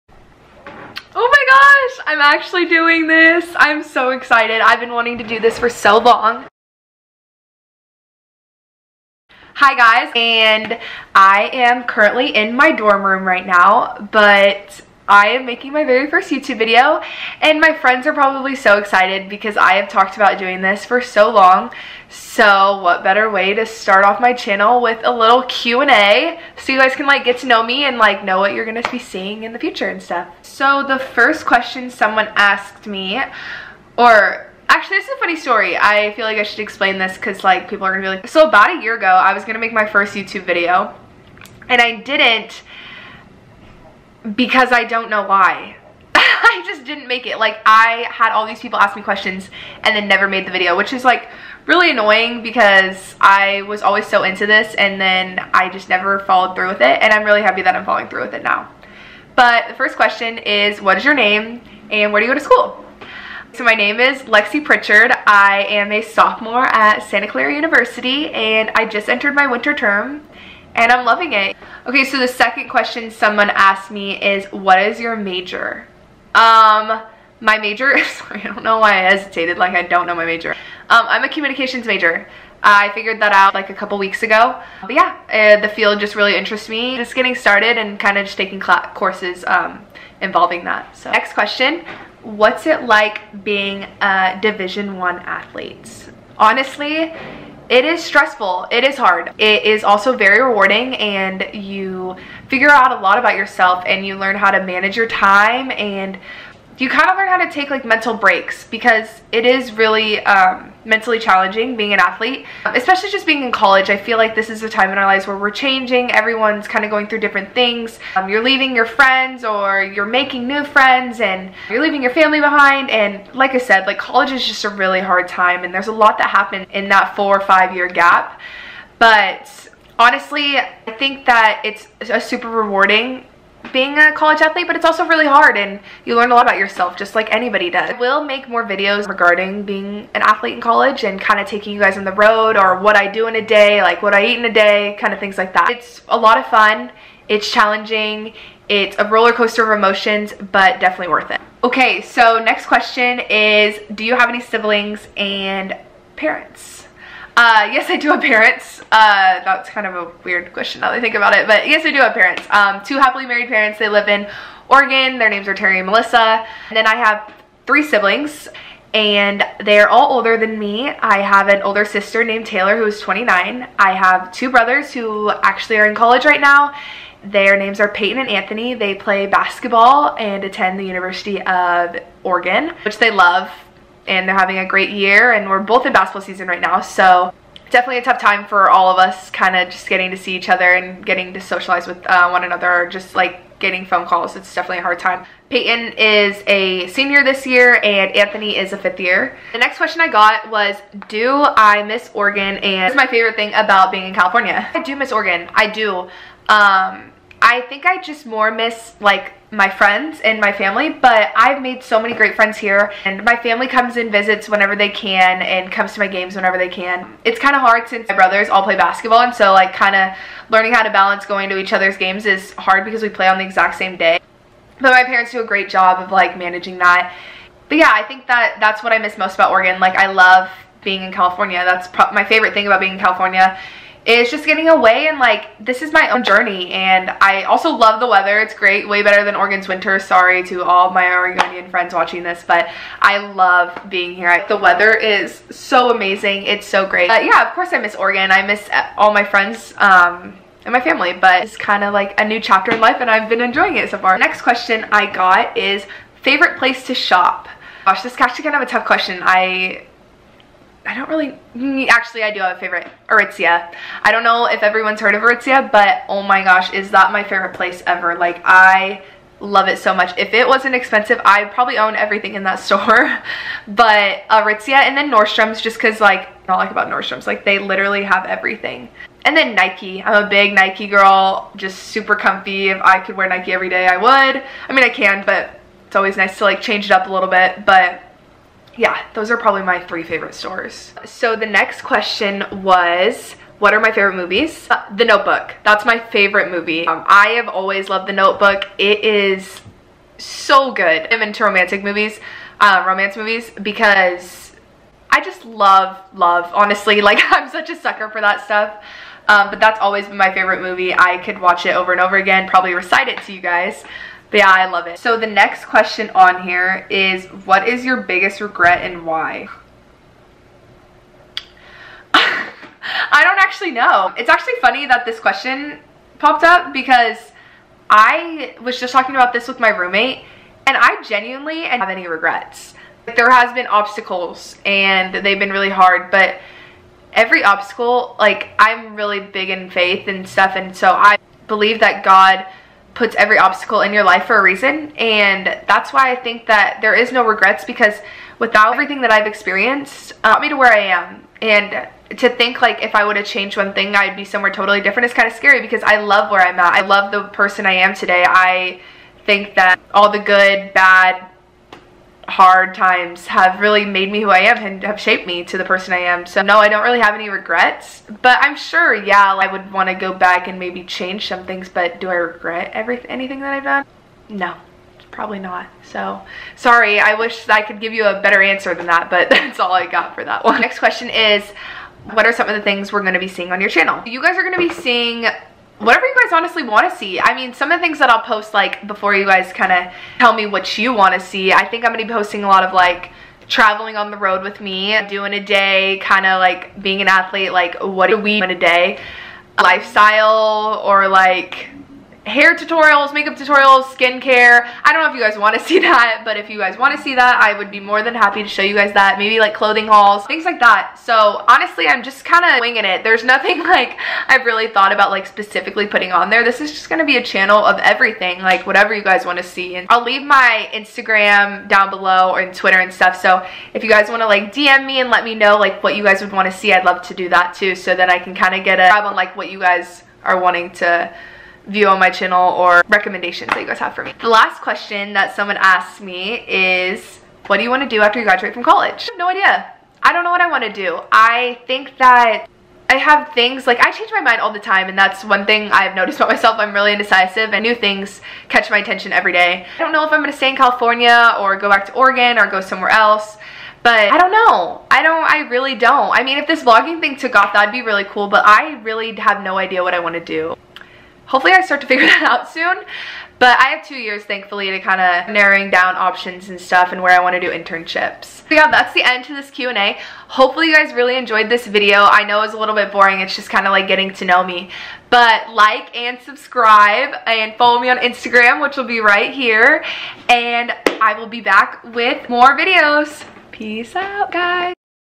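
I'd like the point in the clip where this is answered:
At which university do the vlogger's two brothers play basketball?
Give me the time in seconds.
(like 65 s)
180 s.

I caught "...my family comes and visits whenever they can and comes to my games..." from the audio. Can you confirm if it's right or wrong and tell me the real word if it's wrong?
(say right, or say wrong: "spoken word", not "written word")
right.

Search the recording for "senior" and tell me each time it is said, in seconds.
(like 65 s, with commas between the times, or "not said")
196 s.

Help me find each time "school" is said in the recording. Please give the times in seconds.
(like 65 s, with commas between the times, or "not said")
62 s.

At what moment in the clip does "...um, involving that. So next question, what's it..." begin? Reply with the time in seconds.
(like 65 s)
89 s.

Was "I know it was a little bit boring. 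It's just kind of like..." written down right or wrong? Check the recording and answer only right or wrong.
right.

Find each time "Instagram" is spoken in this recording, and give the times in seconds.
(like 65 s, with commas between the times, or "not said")
420 s, 477 s.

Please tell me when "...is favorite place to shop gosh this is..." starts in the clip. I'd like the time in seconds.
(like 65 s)
255 s.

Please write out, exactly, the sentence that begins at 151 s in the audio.
Okay, so next question is, do you have any siblings and parents?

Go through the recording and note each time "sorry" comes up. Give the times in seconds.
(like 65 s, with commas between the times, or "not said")
78 s, 239 s, 376 s.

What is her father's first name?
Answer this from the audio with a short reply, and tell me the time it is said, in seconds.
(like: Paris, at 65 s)
Terry, at 165 s.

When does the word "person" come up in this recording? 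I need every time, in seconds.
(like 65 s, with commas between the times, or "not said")
357 s, 365 s.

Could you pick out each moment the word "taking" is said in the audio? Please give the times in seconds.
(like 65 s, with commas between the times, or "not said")
88 s, 141 s.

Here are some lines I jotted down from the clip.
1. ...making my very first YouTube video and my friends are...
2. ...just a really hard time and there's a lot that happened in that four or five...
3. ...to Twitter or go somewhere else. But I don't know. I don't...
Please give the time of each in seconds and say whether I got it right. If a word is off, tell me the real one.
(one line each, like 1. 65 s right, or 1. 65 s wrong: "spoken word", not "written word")
1. 15 s right
2. 124 s right
3. 451 s wrong: "Oregon", not "Twitter".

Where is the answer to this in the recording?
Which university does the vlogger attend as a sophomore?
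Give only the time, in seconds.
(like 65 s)
67 s.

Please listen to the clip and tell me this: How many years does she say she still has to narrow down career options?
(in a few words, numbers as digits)
2.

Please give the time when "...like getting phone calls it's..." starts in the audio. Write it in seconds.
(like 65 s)
193 s.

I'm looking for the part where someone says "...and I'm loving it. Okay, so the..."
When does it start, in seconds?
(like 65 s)
70 s.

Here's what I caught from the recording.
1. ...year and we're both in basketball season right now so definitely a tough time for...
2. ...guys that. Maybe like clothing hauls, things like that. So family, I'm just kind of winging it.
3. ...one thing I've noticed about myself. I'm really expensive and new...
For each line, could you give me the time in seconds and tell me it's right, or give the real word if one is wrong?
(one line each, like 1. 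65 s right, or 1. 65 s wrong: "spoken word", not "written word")
1. 184 s right
2. 408 s wrong: "honestly", not "family"
3. 445 s wrong: "indecisive", not "expensive".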